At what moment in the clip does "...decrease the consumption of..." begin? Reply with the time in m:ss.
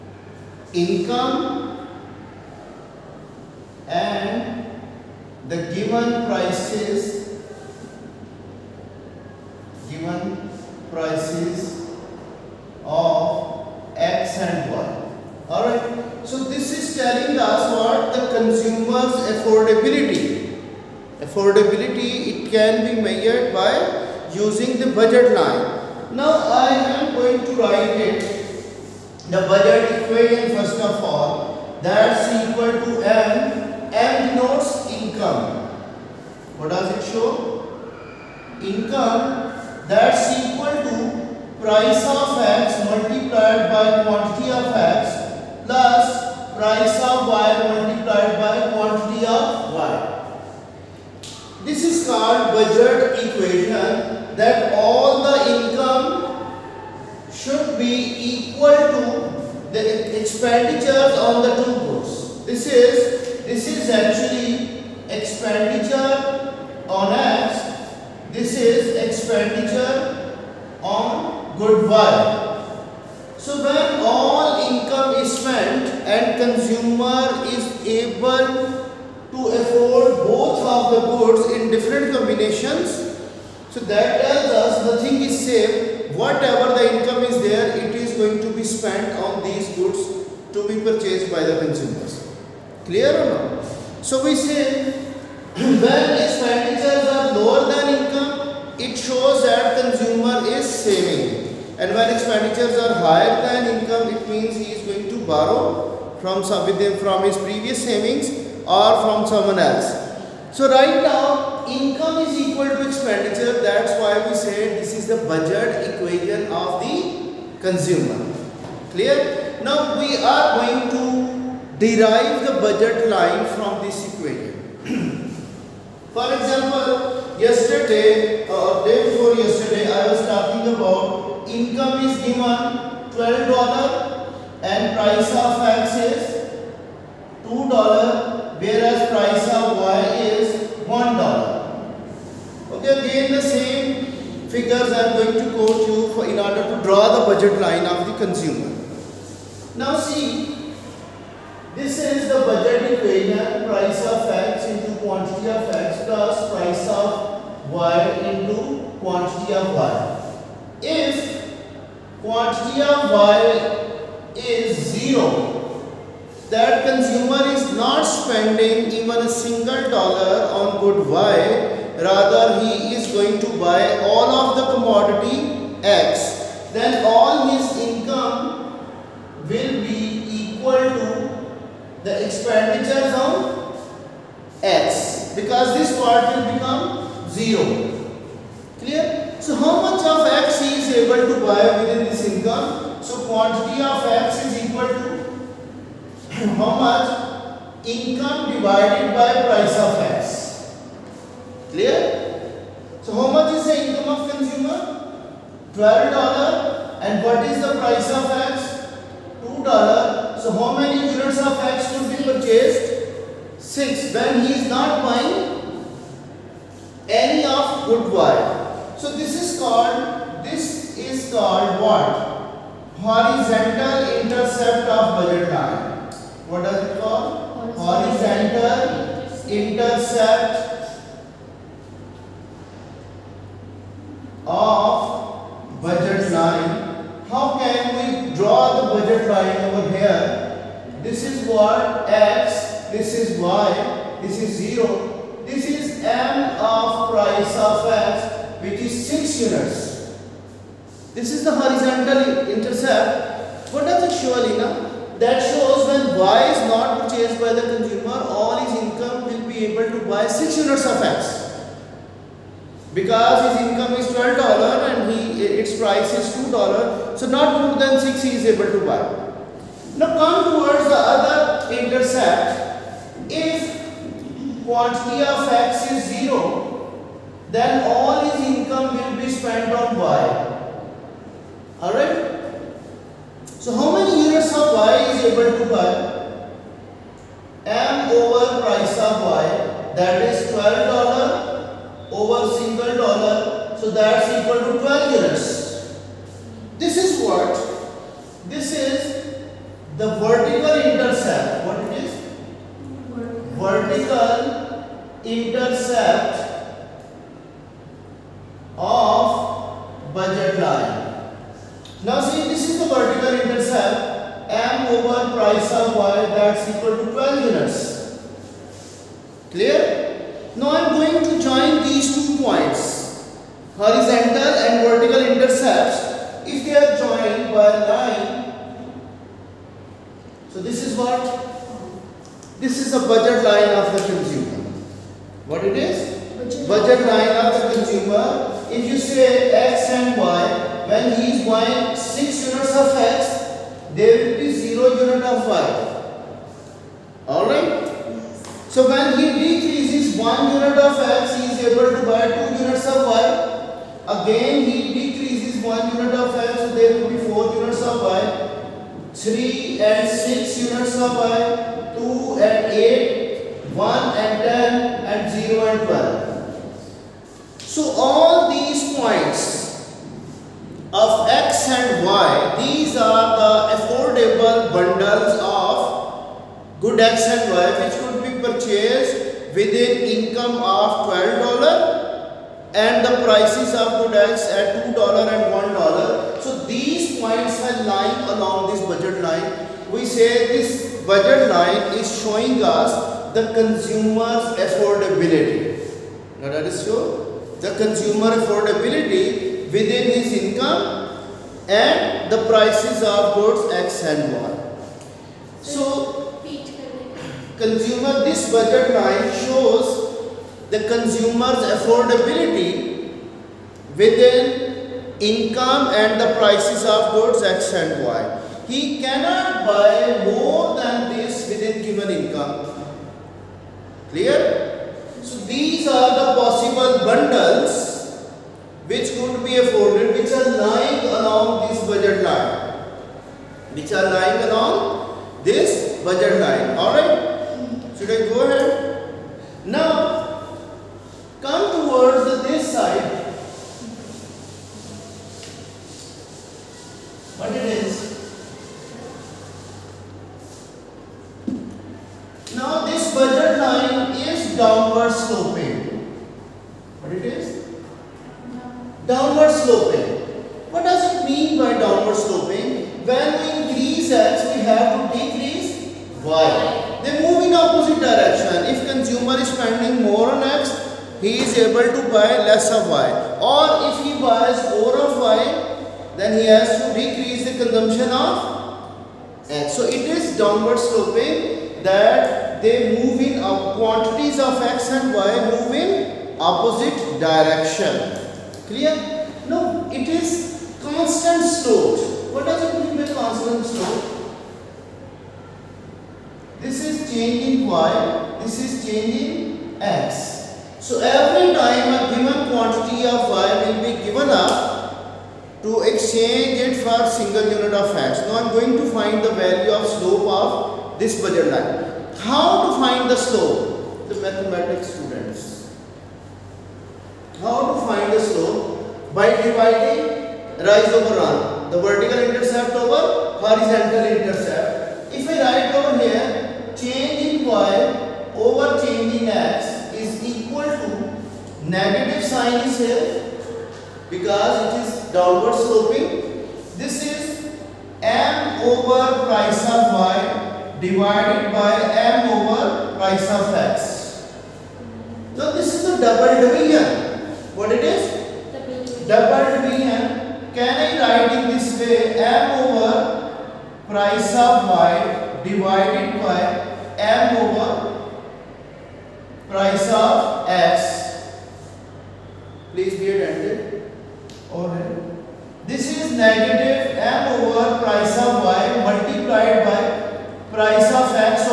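7:56.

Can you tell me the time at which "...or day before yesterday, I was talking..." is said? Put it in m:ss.
2:08.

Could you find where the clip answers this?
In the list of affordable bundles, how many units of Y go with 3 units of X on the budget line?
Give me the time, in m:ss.
5:59.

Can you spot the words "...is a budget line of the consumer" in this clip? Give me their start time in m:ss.
5:32.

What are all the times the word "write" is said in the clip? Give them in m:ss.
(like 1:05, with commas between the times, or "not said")
0:27, 8:45, 9:11.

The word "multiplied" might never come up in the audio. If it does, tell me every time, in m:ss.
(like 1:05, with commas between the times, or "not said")
0:42, 0:47, 9:28.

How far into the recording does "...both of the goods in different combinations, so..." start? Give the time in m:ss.
1:20.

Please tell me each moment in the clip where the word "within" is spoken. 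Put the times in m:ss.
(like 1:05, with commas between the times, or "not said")
1:46, 3:11, 6:19, 6:39, 6:53, 7:01.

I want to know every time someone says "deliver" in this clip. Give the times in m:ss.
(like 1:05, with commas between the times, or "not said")
not said.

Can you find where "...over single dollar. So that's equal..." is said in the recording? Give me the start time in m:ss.
4:52.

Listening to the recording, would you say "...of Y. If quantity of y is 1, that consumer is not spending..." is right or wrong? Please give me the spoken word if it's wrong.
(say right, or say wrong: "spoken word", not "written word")
wrong: "0", not "1".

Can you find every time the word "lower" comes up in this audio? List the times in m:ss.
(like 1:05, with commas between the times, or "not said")
1:37.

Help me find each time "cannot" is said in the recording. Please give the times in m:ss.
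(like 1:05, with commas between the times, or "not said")
6:59.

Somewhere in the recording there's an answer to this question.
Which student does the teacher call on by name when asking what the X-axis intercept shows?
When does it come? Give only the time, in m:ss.
4:14.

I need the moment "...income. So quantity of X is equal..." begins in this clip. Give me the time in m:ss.
3:12.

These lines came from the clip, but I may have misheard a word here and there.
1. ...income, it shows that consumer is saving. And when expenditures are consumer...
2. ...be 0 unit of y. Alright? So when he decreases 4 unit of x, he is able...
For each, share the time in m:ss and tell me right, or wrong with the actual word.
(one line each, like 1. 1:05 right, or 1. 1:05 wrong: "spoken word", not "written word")
1. 1:38 wrong: "higher", not "consumer"
2. 5:44 wrong: "1", not "4".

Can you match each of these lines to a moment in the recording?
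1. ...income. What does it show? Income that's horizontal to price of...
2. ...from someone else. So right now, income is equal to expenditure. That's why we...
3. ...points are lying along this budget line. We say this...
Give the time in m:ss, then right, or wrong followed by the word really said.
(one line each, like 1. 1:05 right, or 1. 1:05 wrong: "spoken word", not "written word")
1. 0:34 wrong: "equal", not "horizontal"
2. 1:49 right
3. 6:27 right.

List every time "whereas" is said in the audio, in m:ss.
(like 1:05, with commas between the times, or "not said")
2:18.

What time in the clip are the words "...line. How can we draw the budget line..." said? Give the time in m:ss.
3:56.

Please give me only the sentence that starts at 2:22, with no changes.
Okay, again the same figures I am going to quote you for in order to draw the budget line of the consumer.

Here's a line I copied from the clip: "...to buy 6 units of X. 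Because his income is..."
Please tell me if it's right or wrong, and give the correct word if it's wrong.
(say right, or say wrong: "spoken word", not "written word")
right.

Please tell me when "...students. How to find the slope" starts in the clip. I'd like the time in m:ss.
8:34.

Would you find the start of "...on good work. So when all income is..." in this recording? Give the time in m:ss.
1:10.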